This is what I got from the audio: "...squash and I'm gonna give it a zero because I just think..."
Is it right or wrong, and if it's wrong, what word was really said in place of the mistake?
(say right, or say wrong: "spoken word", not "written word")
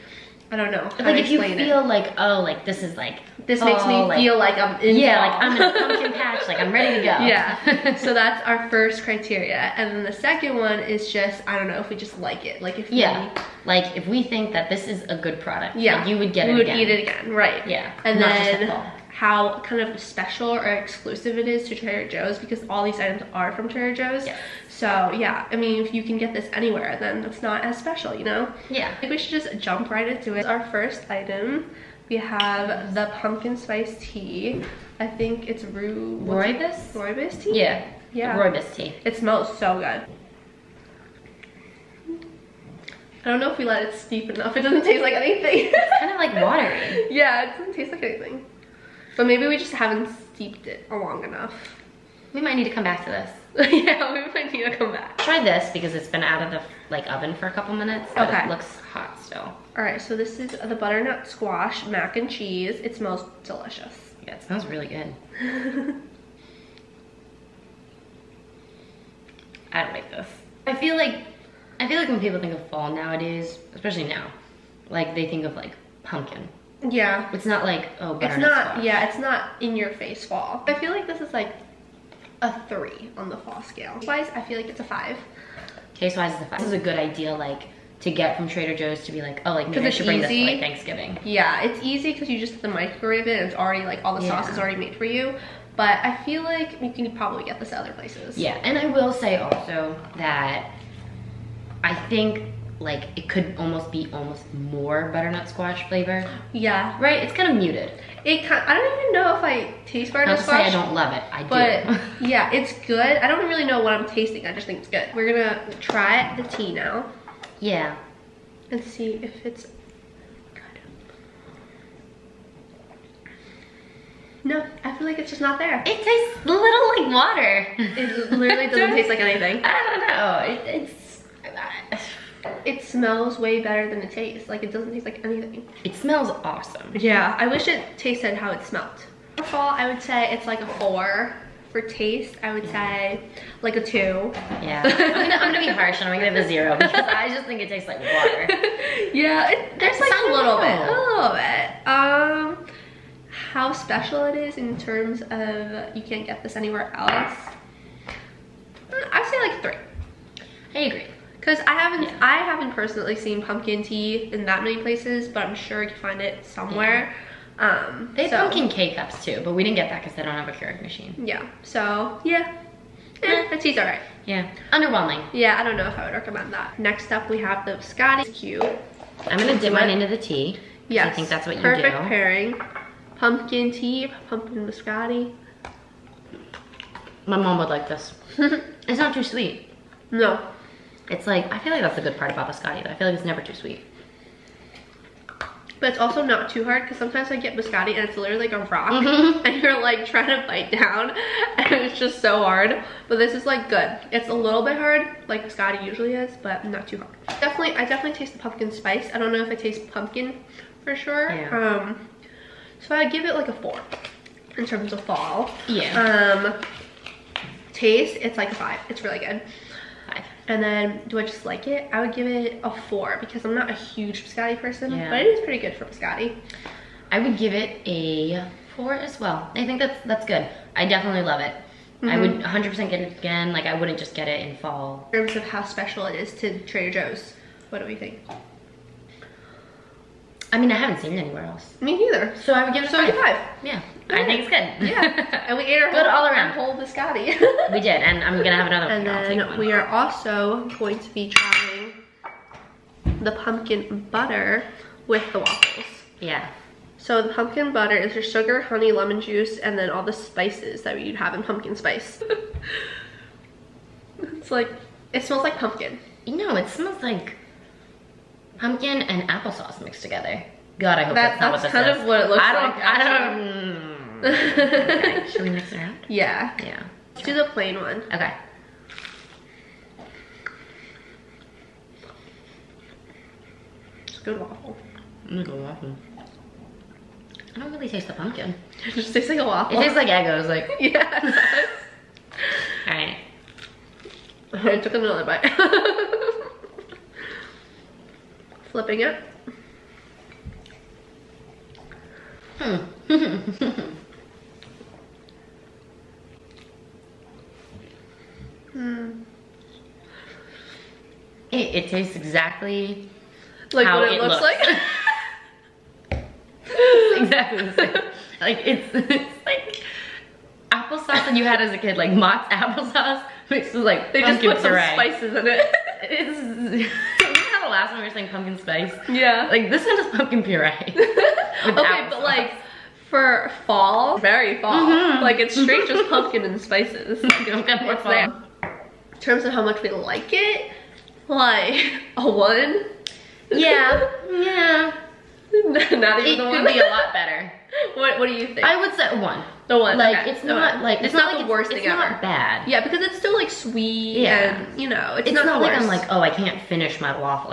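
wrong: "harsh", not "squash".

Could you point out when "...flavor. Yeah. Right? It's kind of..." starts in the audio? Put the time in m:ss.
1:45.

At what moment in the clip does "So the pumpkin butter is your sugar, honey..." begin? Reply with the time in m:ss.
4:16.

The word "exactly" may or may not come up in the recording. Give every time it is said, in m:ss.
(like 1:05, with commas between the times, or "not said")
5:12, 5:17.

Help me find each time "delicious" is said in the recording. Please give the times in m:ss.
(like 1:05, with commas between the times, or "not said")
1:03.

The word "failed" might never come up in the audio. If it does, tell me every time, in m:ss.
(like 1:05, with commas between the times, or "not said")
not said.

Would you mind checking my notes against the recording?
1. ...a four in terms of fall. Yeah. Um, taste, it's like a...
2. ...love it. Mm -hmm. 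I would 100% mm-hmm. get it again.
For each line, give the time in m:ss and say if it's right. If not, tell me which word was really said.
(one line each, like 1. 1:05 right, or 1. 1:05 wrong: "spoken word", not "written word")
1. 3:33 right
2. 3:51 right.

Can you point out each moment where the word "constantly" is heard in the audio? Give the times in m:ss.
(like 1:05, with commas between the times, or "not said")
not said.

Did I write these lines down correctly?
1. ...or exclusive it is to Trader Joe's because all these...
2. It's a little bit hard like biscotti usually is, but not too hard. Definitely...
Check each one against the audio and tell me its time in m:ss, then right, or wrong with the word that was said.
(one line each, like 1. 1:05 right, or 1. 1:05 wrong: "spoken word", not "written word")
1. 0:20 right
2. 3:24 right.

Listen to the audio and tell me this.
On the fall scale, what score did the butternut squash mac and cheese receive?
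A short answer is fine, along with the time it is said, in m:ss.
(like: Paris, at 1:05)
3, at 1:22.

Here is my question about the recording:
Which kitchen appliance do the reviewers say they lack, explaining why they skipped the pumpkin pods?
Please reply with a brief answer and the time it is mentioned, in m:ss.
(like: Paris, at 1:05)
Keurig machine, at 2:50.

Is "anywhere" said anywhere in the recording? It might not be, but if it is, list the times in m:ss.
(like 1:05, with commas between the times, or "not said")
0:26, 2:36, 4:01.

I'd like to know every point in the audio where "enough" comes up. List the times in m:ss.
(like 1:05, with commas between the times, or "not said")
0:44, 0:51.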